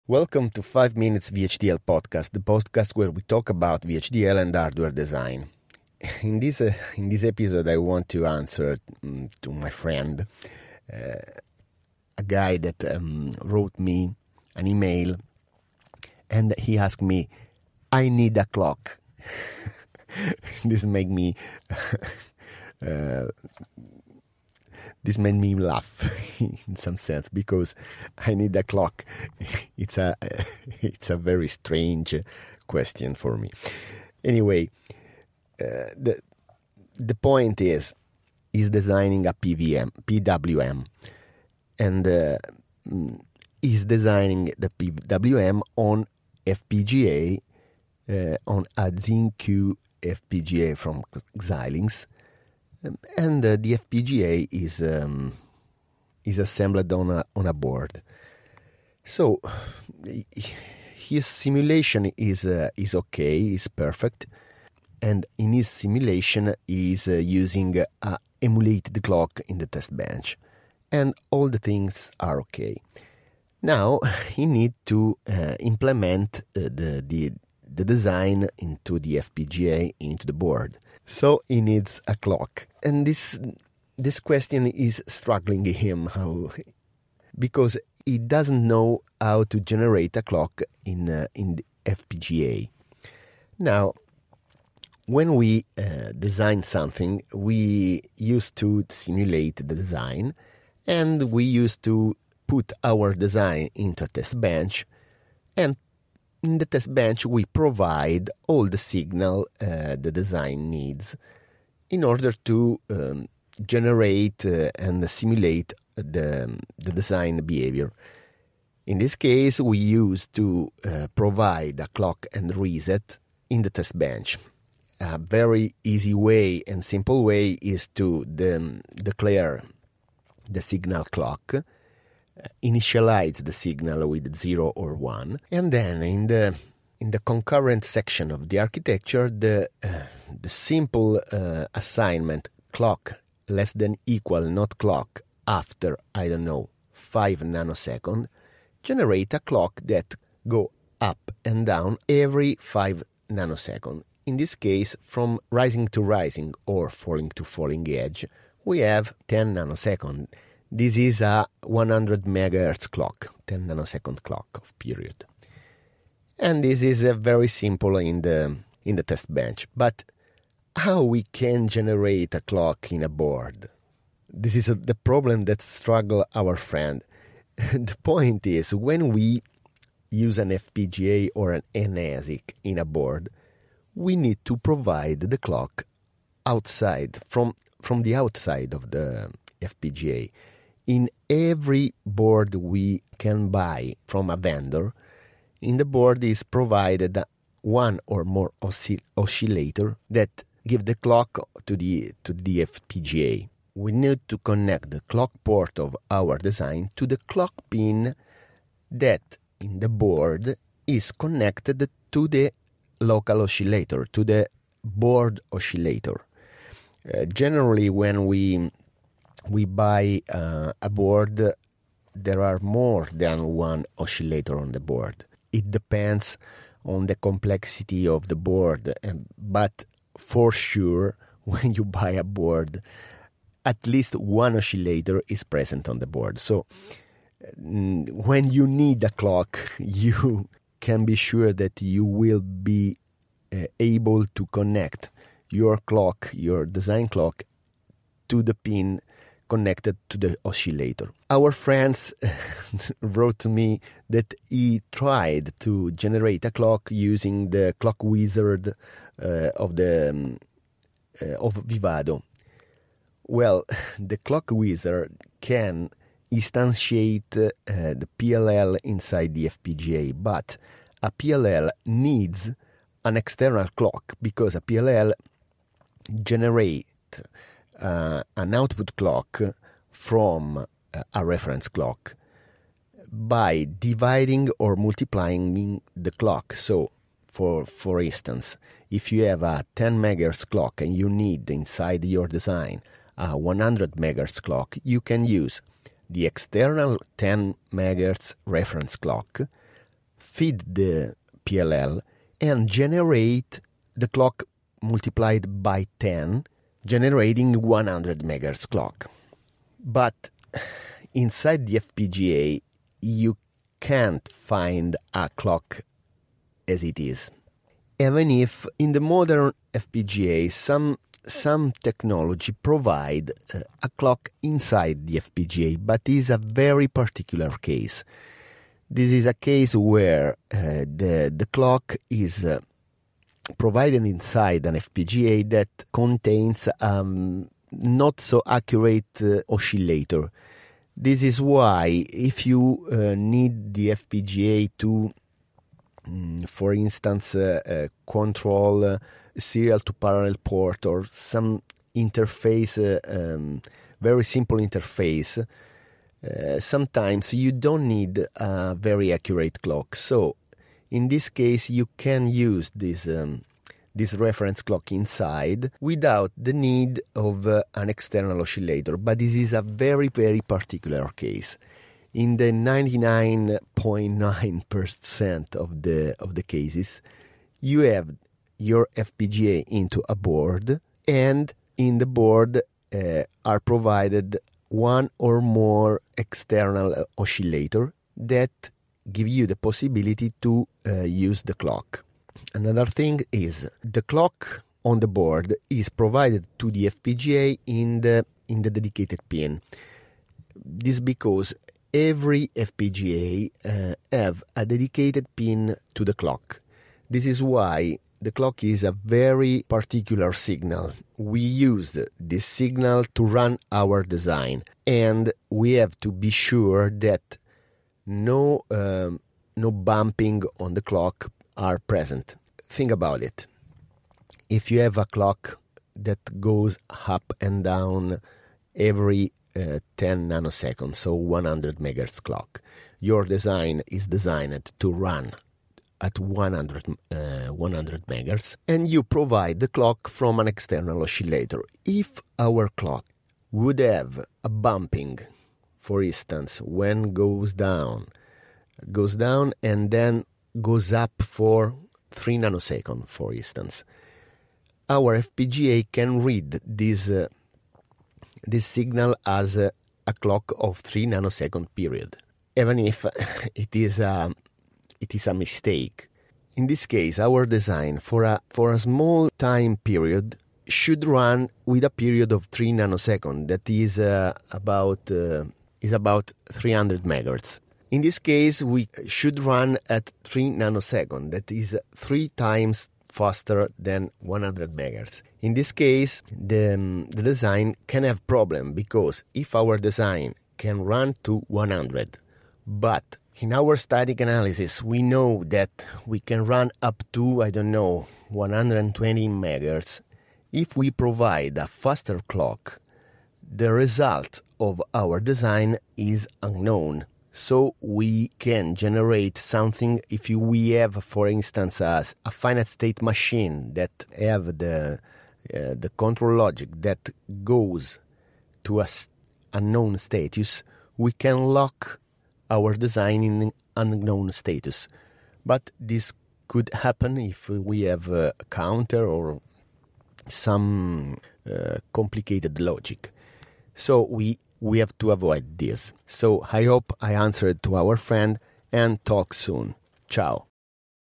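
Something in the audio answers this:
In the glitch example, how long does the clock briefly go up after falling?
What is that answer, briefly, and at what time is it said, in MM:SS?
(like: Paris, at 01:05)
3 nanoseconds, at 07:30.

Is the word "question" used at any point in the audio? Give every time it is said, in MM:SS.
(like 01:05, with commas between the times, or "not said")
00:32, 01:24.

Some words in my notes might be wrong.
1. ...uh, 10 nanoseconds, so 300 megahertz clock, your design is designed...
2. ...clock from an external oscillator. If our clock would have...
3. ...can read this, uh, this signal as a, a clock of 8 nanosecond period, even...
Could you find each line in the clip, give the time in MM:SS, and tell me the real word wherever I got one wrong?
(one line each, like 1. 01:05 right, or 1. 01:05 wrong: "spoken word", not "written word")
1. 07:09 wrong: "100", not "300"
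2. 07:19 right
3. 07:35 wrong: "3", not "8".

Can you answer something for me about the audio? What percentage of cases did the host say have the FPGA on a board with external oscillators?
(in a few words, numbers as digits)
99.9%.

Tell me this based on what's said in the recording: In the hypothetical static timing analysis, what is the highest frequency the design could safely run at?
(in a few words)
120 megahertz.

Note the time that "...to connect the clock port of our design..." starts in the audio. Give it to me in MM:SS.
03:24.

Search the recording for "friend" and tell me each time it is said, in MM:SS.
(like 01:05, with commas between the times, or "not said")
00:09, 02:56, 04:11, 08:57.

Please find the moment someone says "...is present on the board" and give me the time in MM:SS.
03:55.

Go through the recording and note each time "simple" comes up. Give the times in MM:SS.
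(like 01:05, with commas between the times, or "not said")
02:06, 02:20, 02:47, 05:54.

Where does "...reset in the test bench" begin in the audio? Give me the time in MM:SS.
02:02.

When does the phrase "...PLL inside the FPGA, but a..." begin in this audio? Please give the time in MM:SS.
04:28.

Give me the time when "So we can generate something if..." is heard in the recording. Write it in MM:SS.
08:27.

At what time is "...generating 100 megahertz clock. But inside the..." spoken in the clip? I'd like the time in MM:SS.
05:06.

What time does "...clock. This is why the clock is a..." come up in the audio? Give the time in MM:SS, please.
06:46.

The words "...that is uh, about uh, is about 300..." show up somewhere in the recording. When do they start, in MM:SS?
07:53.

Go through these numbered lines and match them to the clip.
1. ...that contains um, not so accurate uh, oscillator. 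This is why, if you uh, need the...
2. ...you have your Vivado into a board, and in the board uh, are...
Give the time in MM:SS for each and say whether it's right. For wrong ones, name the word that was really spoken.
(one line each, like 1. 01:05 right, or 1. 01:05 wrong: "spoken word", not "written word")
1. 05:35 right
2. 06:17 wrong: "FPGA", not "Vivado".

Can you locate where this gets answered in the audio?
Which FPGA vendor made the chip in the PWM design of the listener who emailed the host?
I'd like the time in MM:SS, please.
00:51.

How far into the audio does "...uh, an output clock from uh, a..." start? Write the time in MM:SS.
04:37.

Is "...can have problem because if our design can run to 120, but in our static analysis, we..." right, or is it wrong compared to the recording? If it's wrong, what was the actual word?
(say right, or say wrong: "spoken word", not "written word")
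wrong: "100", not "120".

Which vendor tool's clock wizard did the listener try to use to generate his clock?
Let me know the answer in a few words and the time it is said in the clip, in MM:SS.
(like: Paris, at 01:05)
Vivado, at 04:21.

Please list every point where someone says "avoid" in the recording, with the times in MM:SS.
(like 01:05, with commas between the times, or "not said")
08:55.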